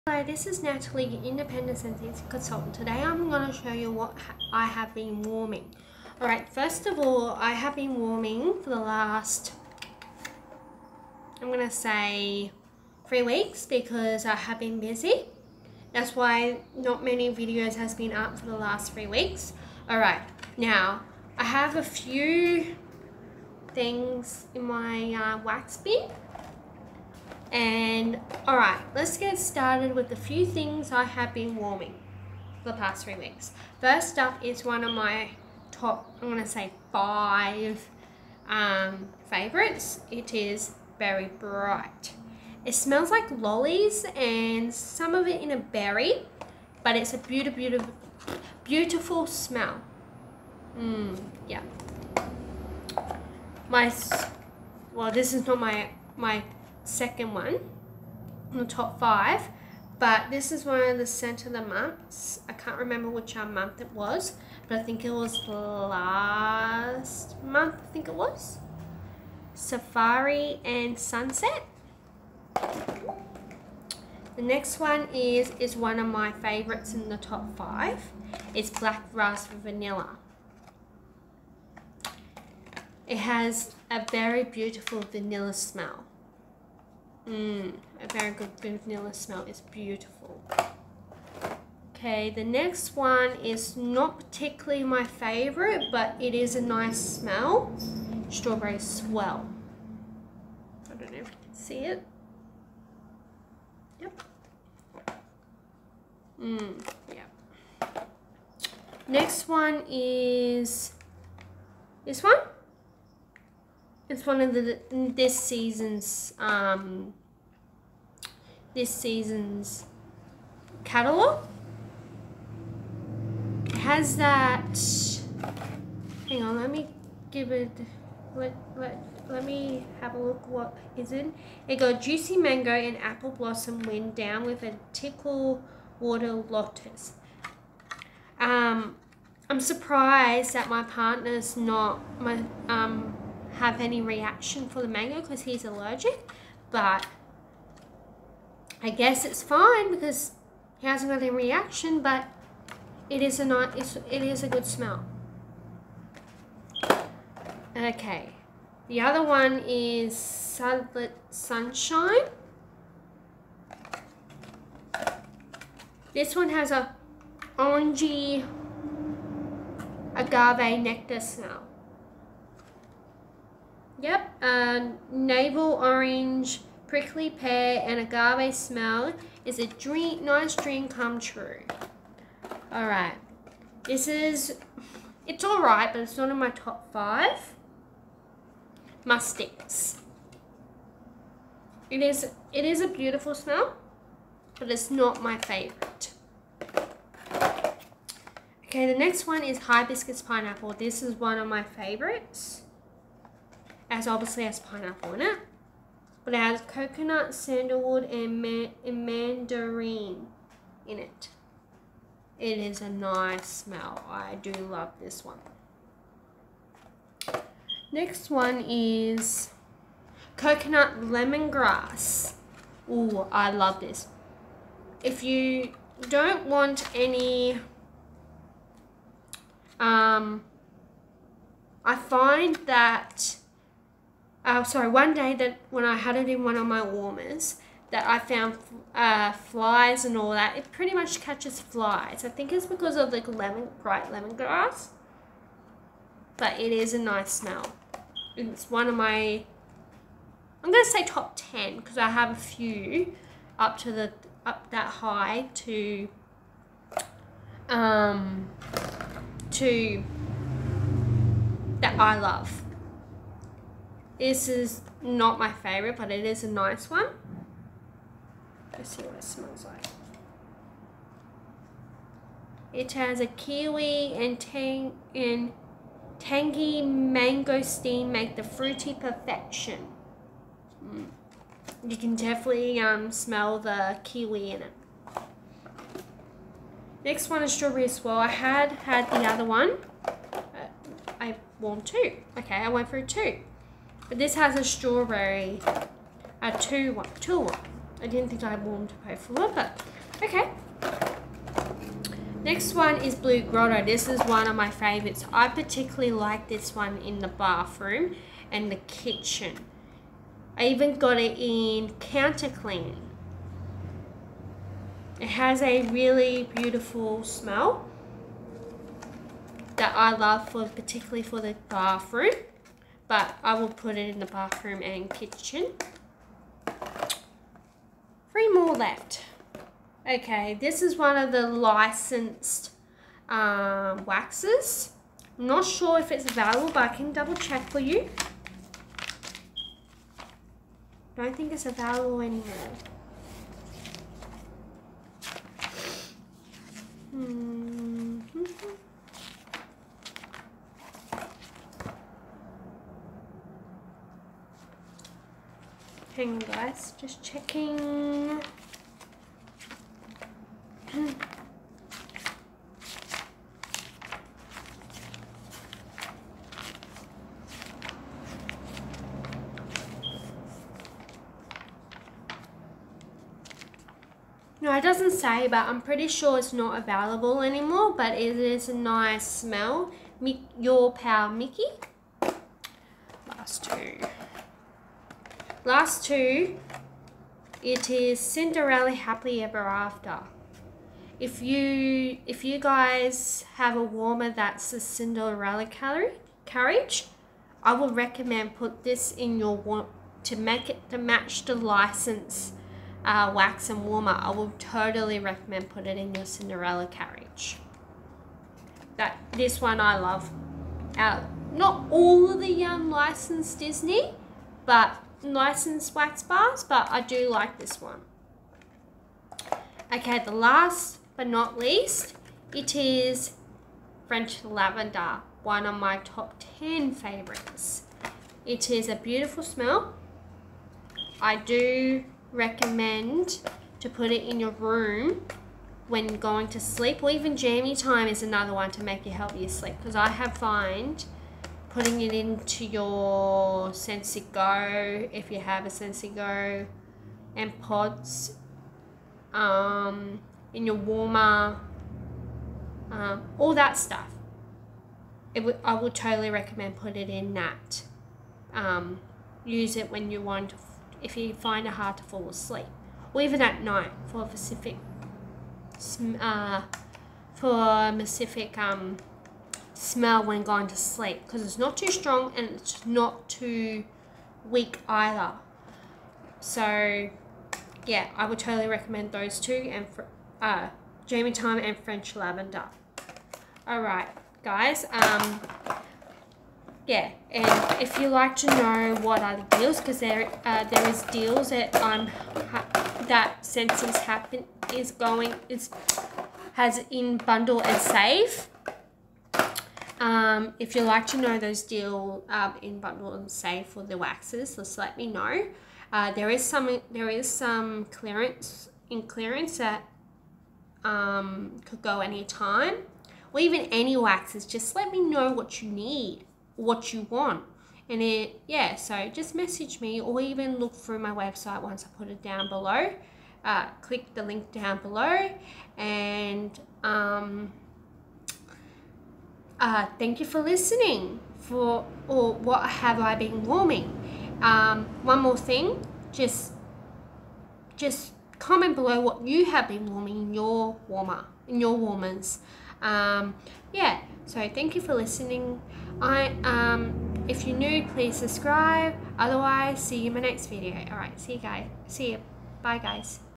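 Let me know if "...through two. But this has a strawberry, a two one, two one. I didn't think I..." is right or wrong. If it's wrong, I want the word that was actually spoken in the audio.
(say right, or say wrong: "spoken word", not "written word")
right.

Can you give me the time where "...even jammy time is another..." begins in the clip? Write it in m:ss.
7:17.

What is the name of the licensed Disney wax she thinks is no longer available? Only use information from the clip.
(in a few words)
Mi Your Pal Mickey.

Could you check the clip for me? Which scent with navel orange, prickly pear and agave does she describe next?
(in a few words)
Sunlit Sunshine.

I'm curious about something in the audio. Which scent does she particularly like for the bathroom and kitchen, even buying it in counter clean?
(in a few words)
Blue Grotto.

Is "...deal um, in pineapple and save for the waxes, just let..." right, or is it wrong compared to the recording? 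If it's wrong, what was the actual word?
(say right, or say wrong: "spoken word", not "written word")
wrong: "bundle", not "pineapple".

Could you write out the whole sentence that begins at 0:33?
First up is one of my top, I'm gonna say five um, favorites.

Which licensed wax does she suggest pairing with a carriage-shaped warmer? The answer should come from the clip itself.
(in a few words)
Cinderella Happily Ever After.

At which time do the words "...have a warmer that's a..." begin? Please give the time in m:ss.
6:33.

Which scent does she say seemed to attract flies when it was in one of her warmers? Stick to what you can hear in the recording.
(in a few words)
Coconut Lemongrass.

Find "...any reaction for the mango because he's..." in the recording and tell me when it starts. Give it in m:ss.
2:23.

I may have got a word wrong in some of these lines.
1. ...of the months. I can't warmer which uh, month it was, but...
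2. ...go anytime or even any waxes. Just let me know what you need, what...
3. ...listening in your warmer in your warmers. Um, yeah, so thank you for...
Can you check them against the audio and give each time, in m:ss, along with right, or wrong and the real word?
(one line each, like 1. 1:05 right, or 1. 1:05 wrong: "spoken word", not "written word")
1. 1:01 wrong: "remember", not "warmer"
2. 8:31 right
3. 8:59 wrong: "warming", not "listening".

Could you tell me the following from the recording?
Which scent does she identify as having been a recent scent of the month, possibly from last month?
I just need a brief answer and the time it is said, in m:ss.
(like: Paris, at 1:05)
Safari and Sunset, at 1:09.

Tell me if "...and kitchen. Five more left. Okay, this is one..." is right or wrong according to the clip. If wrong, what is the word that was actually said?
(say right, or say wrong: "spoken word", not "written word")
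wrong: "Three", not "Five".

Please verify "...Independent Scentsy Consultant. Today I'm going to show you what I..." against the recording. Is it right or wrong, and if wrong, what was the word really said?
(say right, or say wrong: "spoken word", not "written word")
right.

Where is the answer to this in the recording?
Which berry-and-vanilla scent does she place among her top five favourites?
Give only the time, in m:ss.
1:18.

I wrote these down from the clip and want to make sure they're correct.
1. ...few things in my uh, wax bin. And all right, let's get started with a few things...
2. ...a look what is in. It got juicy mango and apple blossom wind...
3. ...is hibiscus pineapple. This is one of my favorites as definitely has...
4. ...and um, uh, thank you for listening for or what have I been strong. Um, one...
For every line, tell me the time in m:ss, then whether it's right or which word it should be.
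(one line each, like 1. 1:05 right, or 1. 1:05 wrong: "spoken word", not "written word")
1. 0:21 right
2. 2:10 right
3. 3:19 wrong: "obviously", not "definitely"
4. 8:45 wrong: "warming", not "strong".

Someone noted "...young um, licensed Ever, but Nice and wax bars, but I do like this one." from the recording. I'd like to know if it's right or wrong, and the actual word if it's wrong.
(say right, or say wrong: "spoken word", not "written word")
wrong: "Disney", not "Ever".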